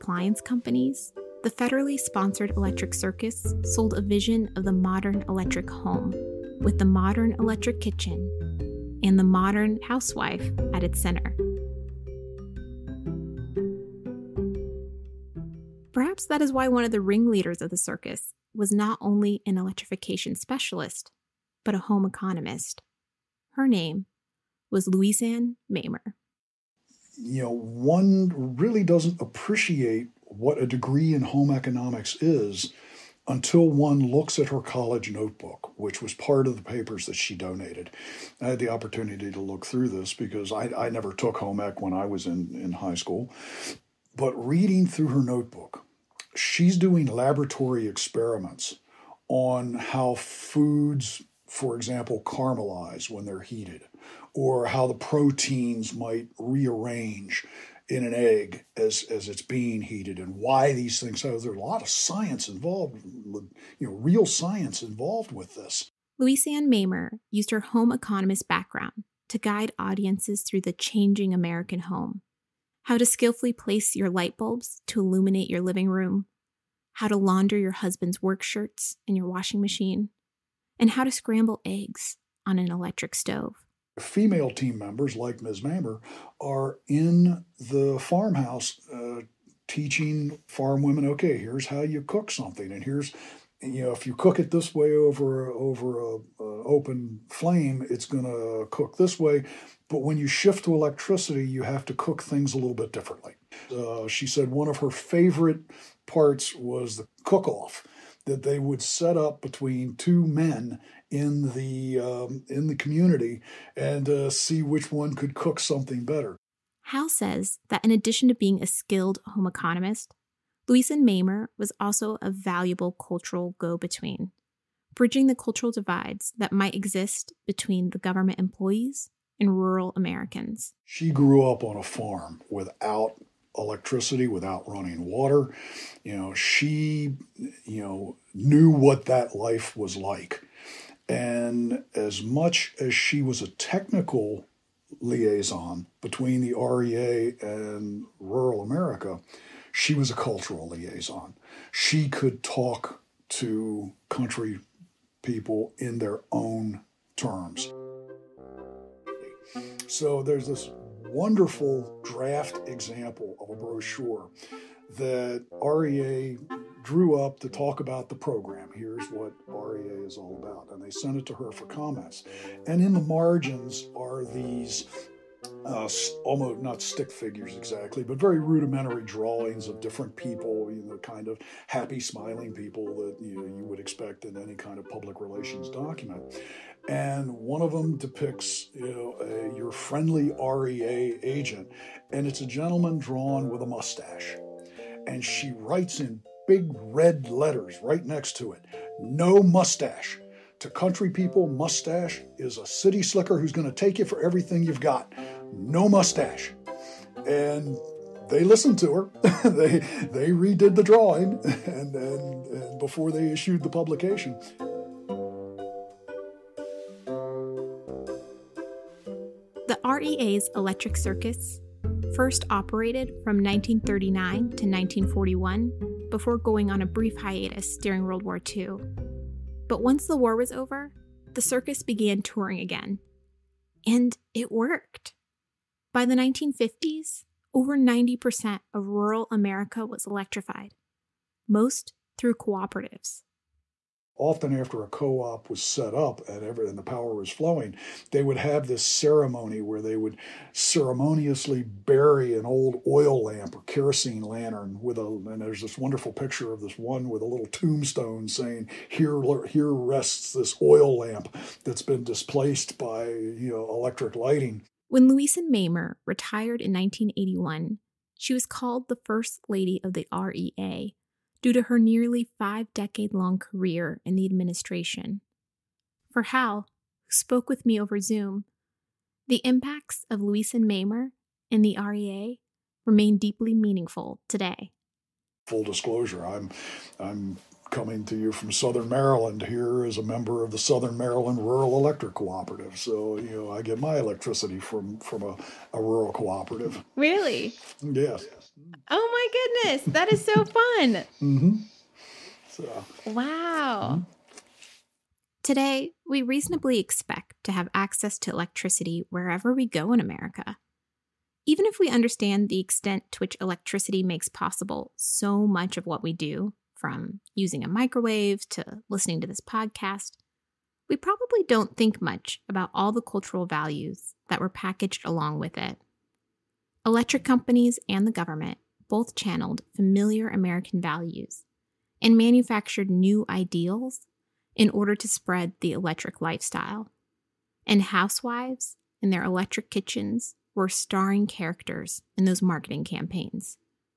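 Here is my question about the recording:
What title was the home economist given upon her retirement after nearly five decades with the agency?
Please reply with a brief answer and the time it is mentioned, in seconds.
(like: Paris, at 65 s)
First Lady of the REA, at 269 s.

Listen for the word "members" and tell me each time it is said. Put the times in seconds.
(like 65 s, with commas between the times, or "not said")
84 s, 290 s.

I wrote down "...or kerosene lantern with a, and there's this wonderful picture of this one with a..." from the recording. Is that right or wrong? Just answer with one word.
right.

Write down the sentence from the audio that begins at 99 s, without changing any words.
But when you shift to electricity, you have to cook things a little bit differently.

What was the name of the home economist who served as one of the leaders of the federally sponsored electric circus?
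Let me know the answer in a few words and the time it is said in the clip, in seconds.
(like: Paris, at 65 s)
Ann Mamer, at 25 s.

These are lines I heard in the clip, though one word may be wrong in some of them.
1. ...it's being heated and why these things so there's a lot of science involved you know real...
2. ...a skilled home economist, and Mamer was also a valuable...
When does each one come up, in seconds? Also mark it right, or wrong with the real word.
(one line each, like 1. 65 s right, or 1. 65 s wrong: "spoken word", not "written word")
1. 59 s right
2. 118 s right.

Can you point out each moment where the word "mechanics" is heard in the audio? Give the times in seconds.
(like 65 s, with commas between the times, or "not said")
not said.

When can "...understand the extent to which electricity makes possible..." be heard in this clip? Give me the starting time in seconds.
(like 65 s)
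311 s.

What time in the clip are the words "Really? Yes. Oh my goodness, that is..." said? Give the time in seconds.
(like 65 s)
296 s.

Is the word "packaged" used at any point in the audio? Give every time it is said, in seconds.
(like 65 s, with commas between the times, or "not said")
324 s.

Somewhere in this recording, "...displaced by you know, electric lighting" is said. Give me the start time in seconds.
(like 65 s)
262 s.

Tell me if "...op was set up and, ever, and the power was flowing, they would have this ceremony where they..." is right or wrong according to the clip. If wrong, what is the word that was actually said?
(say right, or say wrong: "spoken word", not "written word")
right.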